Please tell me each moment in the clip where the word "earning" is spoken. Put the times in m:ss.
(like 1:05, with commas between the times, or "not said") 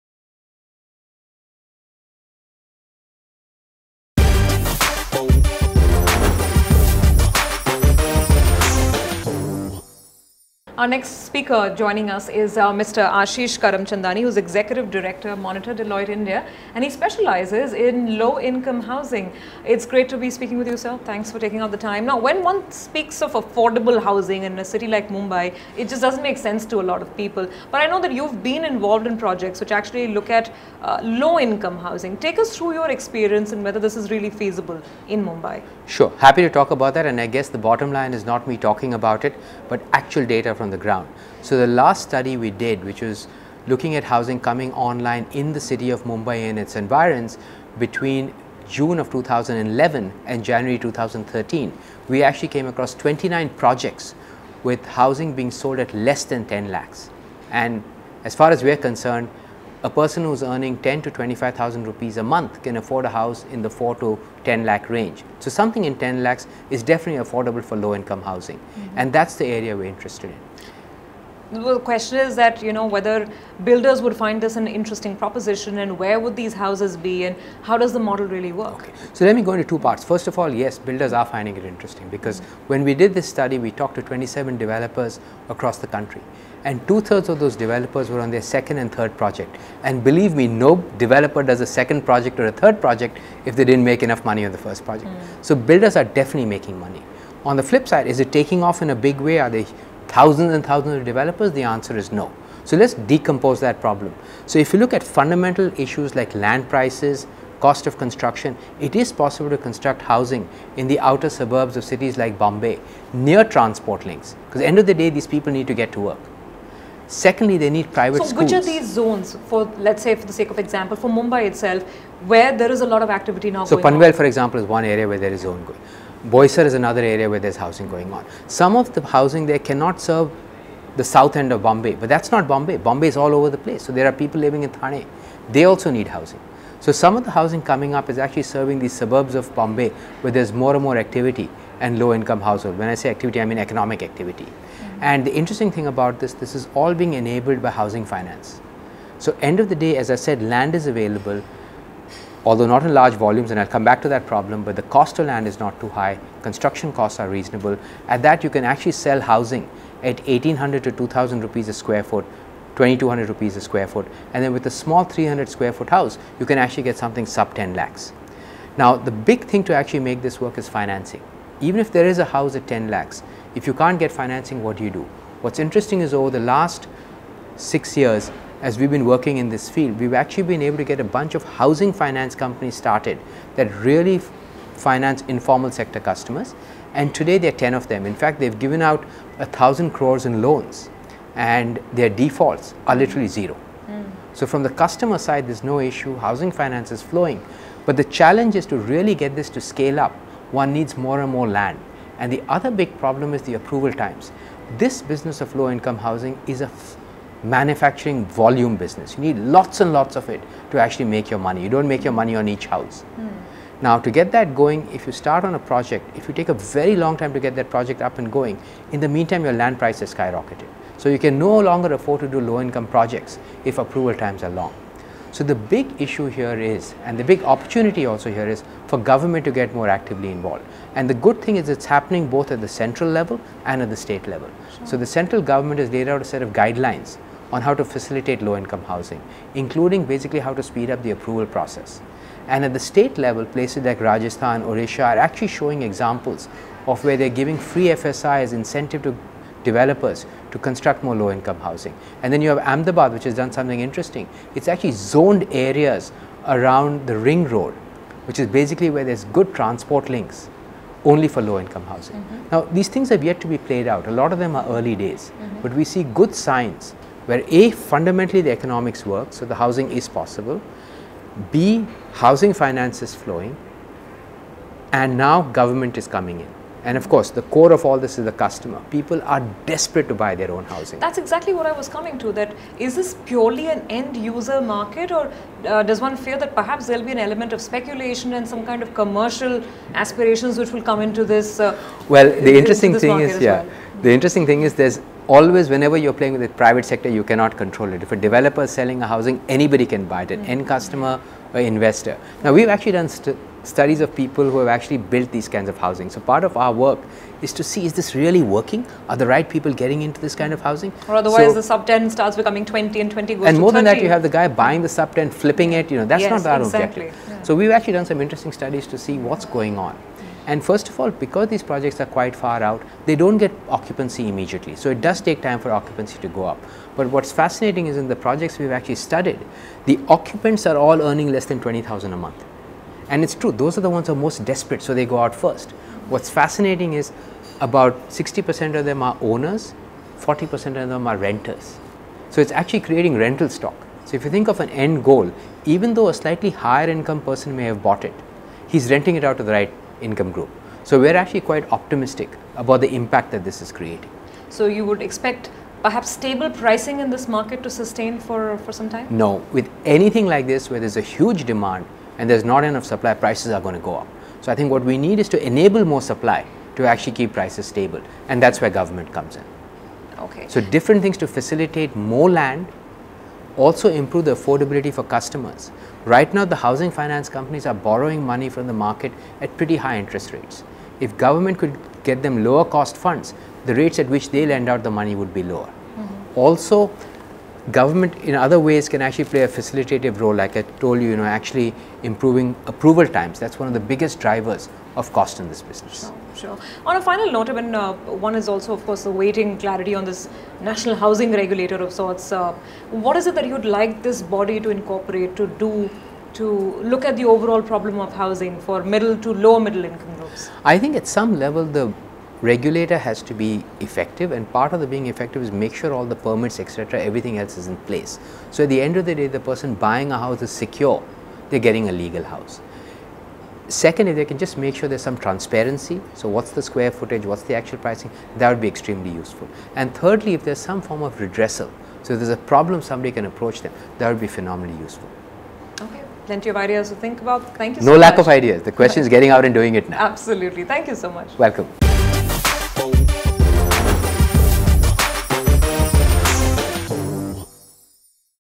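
1:00, 5:31.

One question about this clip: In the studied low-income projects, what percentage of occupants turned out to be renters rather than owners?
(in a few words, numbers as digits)
40%.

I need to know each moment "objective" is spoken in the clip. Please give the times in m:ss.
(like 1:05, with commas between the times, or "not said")
5:17.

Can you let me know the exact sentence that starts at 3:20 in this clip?
One needs more and more land.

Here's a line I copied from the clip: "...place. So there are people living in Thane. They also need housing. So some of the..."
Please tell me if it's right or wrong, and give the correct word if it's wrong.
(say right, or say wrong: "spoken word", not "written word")
right.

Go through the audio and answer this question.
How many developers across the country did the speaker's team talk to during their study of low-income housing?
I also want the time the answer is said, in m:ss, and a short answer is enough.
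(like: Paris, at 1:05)
27, at 1:24.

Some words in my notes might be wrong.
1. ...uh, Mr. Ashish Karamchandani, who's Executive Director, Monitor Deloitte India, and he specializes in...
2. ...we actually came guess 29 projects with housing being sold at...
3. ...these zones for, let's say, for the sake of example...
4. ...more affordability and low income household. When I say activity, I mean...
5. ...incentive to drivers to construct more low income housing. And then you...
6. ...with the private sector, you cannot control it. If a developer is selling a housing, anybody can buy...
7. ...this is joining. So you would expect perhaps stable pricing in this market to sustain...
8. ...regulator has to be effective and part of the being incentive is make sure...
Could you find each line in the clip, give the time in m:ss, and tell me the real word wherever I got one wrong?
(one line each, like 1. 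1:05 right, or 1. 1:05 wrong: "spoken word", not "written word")
1. 0:12 right
2. 0:52 wrong: "across", not "guess"
3. 1:58 right
4. 2:20 wrong: "activity", not "affordability"
5. 4:08 wrong: "developers", not "drivers"
6. 4:56 right
7. 5:53 wrong: "creating", not "joining"
8. 6:52 wrong: "effective", not "incentive".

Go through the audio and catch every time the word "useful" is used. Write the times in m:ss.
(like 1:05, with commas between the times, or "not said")
7:09, 7:14.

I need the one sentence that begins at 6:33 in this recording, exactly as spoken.
That's one of the biggest drivers of cost in this business.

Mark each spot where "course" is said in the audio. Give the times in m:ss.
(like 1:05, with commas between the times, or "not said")
4:37, 6:38.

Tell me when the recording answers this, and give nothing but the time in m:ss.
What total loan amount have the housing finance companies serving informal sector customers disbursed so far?
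3:09.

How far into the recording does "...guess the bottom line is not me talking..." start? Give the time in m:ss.
0:37.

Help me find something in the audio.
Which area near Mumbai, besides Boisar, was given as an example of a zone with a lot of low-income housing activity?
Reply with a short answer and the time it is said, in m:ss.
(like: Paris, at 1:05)
Panvel, at 2:03.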